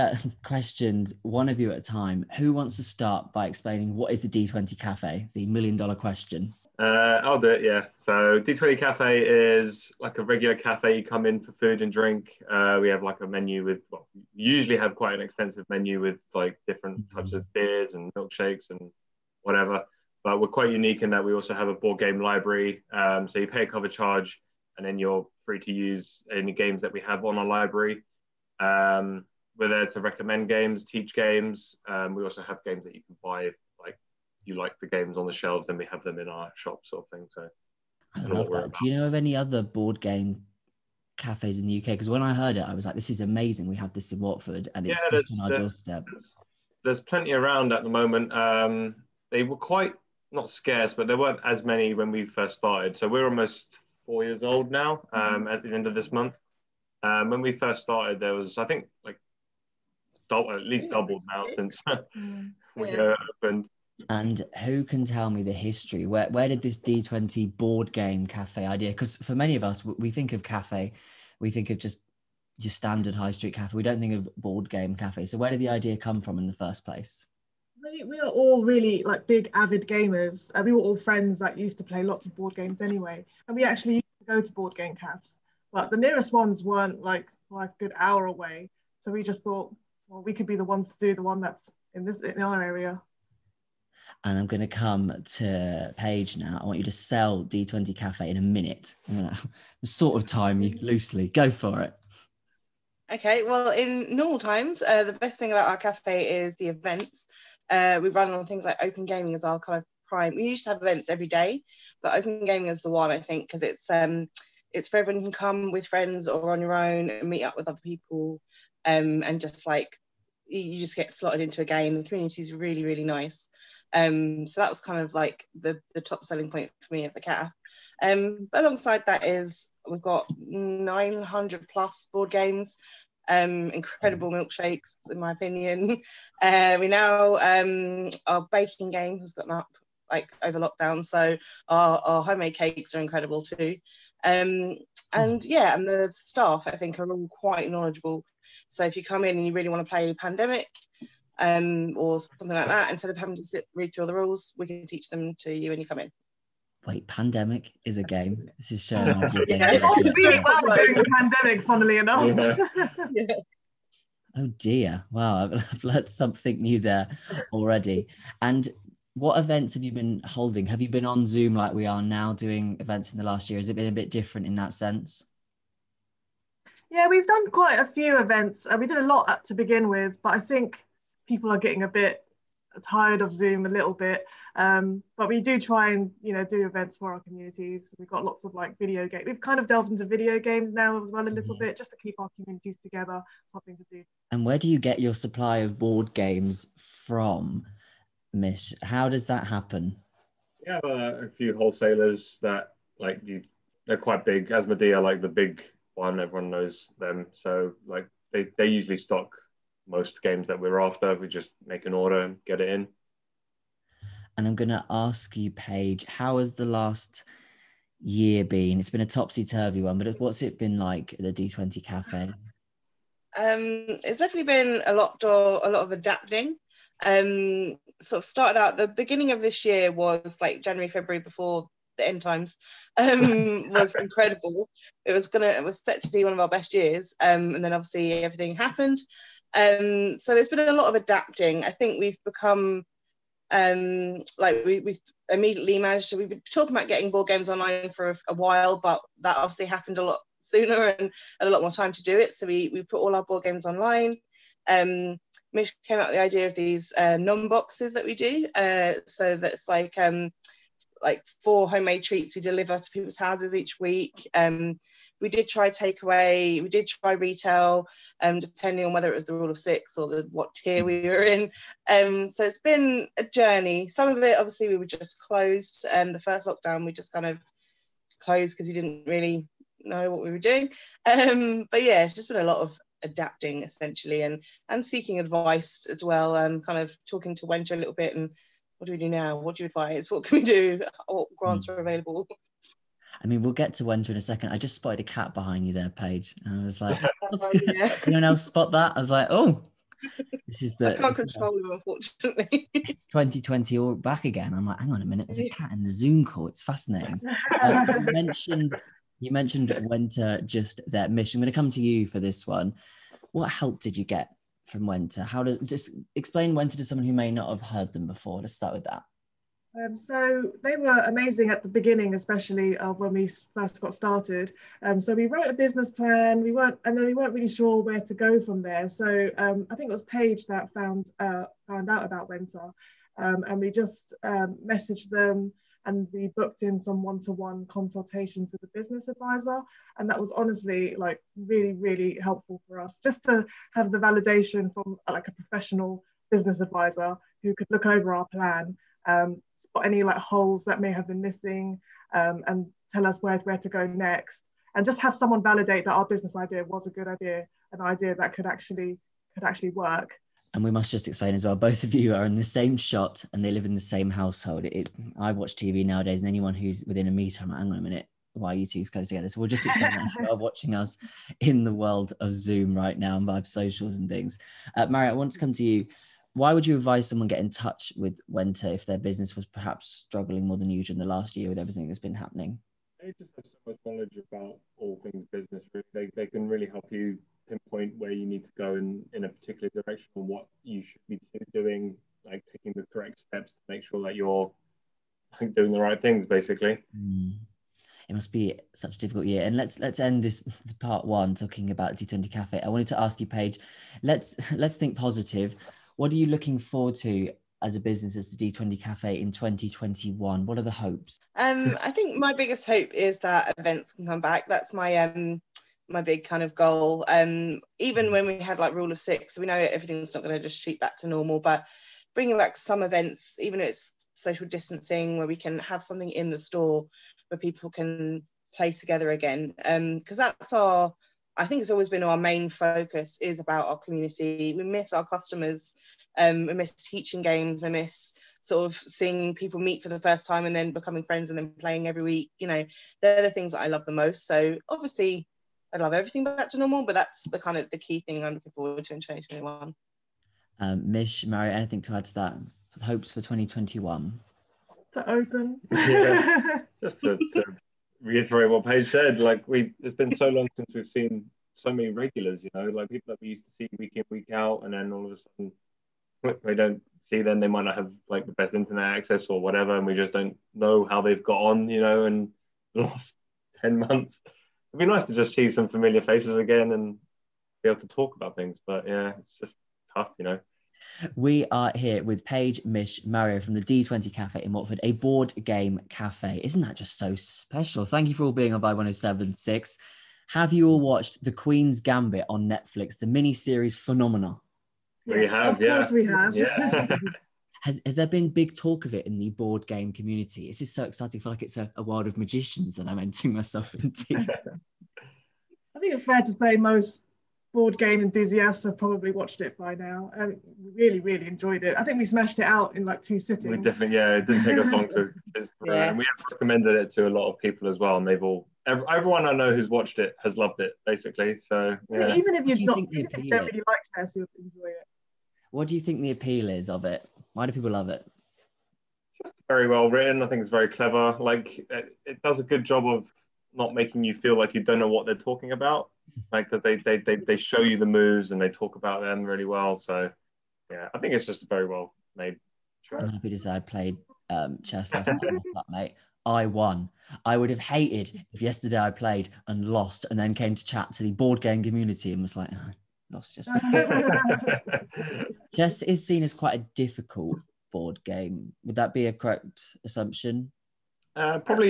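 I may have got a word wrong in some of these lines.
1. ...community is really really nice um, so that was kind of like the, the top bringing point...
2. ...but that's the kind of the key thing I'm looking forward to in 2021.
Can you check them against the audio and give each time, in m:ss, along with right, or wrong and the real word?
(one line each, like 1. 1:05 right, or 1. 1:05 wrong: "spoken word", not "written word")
1. 2:02 wrong: "selling", not "bringing"
2. 7:26 right.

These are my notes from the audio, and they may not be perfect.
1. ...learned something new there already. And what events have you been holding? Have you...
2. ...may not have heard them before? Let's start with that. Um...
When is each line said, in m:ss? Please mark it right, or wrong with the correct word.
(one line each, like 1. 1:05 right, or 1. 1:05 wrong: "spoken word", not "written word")
1. 2:45 right
2. 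5:17 right.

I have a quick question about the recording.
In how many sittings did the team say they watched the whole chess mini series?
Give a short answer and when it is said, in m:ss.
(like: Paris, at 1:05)
2, at 8:33.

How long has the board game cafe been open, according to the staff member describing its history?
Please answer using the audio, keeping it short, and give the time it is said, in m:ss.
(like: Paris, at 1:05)
almost 4 years, at 0:53.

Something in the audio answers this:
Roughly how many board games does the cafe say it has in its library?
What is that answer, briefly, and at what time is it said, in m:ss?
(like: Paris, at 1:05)
900 plus, at 2:10.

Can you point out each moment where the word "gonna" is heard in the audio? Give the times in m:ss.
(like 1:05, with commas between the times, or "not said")
3:34, 3:55.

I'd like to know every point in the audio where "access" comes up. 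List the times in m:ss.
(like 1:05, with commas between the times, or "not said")
7:48.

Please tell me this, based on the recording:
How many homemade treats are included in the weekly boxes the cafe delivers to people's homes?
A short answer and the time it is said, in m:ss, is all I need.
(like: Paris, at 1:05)
4, at 4:21.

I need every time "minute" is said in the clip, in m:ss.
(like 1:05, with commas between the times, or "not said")
1:38, 5:05, 6:07.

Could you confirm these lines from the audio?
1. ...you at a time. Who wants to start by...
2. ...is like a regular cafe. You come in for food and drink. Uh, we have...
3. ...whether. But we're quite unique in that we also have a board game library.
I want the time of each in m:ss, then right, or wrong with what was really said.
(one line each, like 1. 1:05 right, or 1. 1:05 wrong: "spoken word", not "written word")
1. 0:01 right
2. 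0:09 right
3. 0:19 wrong: "whatever", not "whether".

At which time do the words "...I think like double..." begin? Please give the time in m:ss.
0:58.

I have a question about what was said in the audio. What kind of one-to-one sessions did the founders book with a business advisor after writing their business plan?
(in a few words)
consultations.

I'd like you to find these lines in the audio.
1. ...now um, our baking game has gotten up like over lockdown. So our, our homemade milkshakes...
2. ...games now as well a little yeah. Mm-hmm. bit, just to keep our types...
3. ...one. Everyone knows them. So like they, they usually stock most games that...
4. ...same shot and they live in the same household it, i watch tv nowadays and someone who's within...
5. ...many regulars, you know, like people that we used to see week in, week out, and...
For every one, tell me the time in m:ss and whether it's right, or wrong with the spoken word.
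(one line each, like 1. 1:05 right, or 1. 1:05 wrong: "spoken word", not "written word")
1. 2:16 wrong: "cakes", not "milkshakes"
2. 3:10 wrong: "communities", not "types"
3. 3:25 right
4. 6:02 wrong: "anyone", not "someone"
5. 7:41 right.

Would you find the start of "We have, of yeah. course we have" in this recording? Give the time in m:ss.
8:15.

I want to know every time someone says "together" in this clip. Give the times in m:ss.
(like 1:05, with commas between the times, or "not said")
3:12, 6:09, 7:08.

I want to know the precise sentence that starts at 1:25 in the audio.
But the nearest ones weren't like like a good hour away.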